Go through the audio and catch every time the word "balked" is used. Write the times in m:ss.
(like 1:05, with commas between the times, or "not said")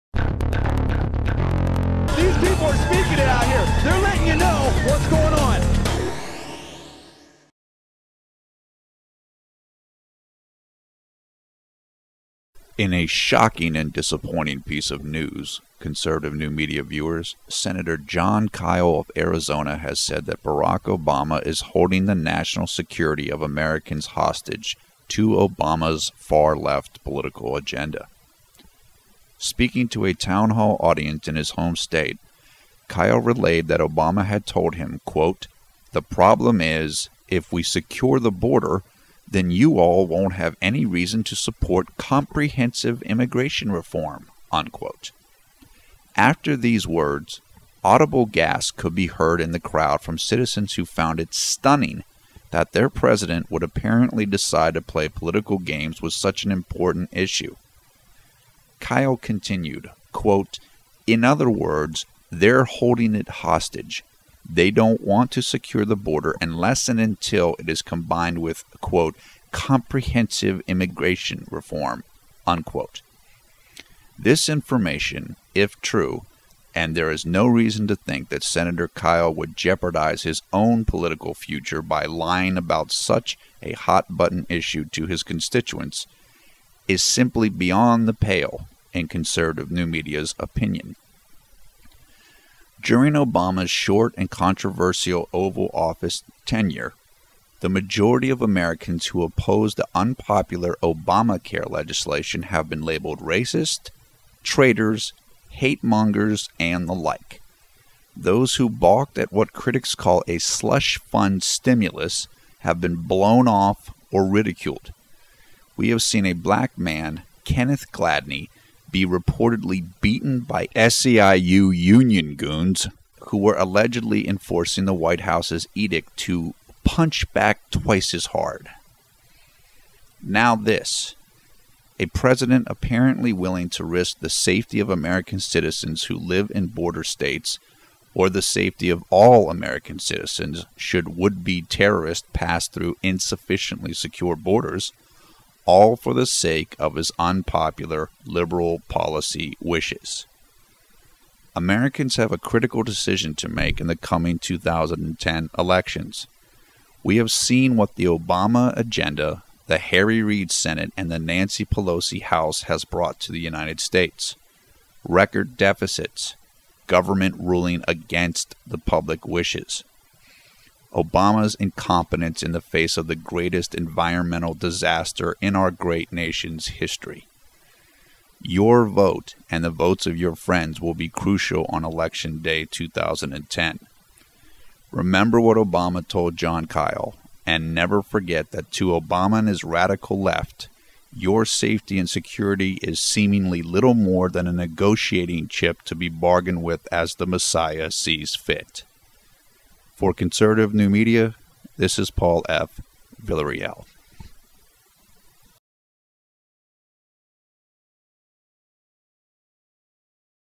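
1:48.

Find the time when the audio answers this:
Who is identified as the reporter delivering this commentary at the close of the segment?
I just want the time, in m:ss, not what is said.
3:22.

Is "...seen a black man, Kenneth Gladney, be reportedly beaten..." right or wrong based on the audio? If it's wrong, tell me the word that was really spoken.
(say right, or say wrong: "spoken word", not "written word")
right.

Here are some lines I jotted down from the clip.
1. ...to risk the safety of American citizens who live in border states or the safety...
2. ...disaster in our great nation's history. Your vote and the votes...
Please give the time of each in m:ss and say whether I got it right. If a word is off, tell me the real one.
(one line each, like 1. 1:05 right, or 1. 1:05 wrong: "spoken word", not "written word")
1. 2:13 right
2. 2:54 right.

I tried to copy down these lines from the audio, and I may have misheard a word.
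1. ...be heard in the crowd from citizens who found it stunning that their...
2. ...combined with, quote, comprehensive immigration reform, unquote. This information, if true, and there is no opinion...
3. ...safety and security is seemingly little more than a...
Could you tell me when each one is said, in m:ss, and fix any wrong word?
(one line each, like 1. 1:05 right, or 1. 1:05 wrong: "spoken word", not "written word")
1. 0:48 right
2. 1:07 wrong: "reason", not "opinion"
3. 3:11 right.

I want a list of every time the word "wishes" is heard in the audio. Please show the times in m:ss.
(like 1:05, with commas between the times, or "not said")
2:29, 2:49.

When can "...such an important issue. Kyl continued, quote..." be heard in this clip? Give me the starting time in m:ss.
0:56.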